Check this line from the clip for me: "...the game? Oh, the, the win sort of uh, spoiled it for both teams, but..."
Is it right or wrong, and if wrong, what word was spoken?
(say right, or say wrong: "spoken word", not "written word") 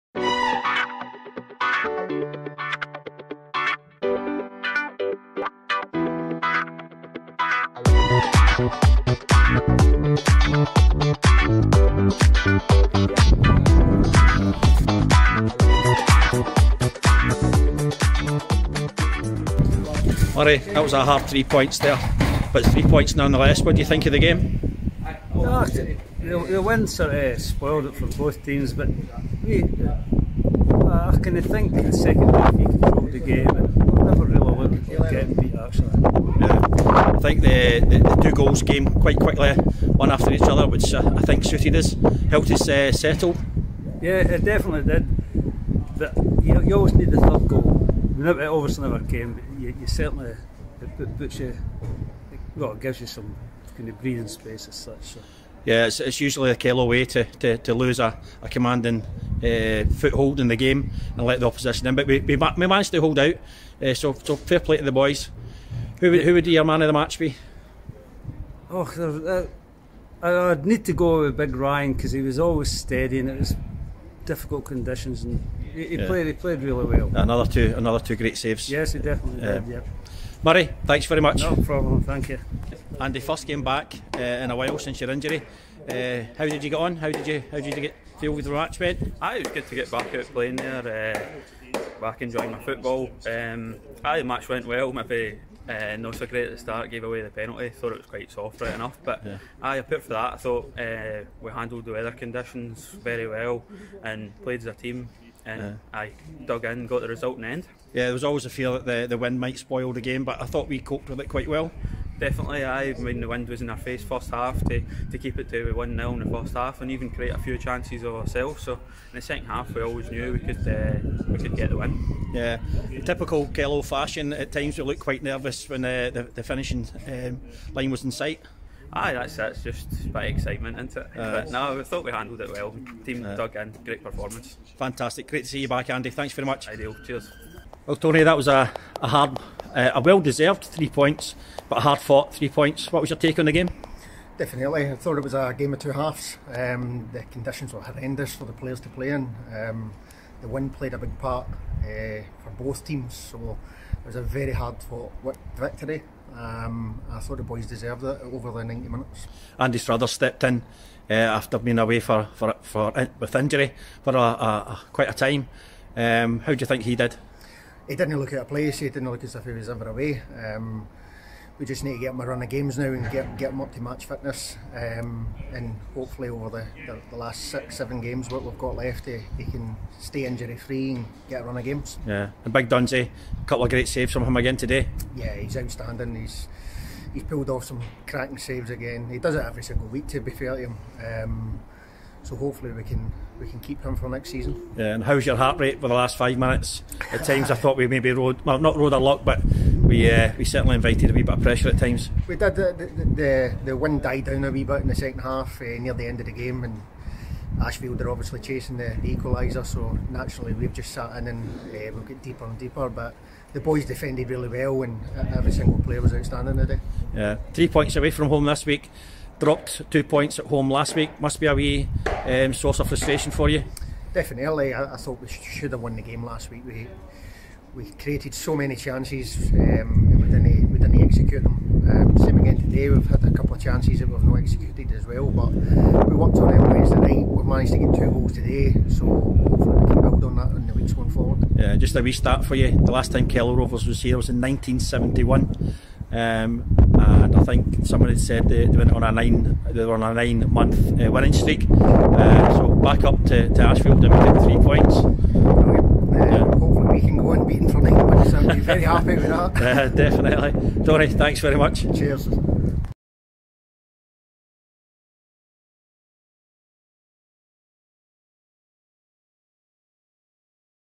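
right.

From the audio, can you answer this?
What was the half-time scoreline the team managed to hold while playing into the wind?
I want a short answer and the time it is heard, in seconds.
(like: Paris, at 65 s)
1-0, at 115 s.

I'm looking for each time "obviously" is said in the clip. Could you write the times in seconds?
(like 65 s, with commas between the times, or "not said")
48 s, 208 s.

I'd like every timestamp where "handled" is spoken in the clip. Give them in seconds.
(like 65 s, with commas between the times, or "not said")
101 s, 132 s.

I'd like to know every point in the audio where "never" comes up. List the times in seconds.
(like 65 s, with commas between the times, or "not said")
34 s, 48 s.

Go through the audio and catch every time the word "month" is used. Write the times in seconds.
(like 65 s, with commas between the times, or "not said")
250 s, 258 s.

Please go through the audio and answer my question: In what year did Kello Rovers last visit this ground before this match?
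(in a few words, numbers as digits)
1971.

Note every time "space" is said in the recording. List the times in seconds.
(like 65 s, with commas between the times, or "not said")
54 s.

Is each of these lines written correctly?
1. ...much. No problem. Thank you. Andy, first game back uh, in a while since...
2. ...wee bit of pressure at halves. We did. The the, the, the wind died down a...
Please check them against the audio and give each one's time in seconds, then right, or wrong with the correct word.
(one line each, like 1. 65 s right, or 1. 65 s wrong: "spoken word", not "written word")
1. 81 s right
2. 201 s wrong: "times", not "halves".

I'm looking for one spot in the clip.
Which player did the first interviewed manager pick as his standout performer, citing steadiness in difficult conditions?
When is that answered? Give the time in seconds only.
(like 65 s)
71 s.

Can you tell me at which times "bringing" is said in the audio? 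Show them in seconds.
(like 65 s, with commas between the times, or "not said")
not said.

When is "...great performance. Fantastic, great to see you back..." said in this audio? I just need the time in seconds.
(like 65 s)
133 s.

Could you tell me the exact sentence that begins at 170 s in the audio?
Um, we just need to get him a run of games now and get, get him up to match fitness.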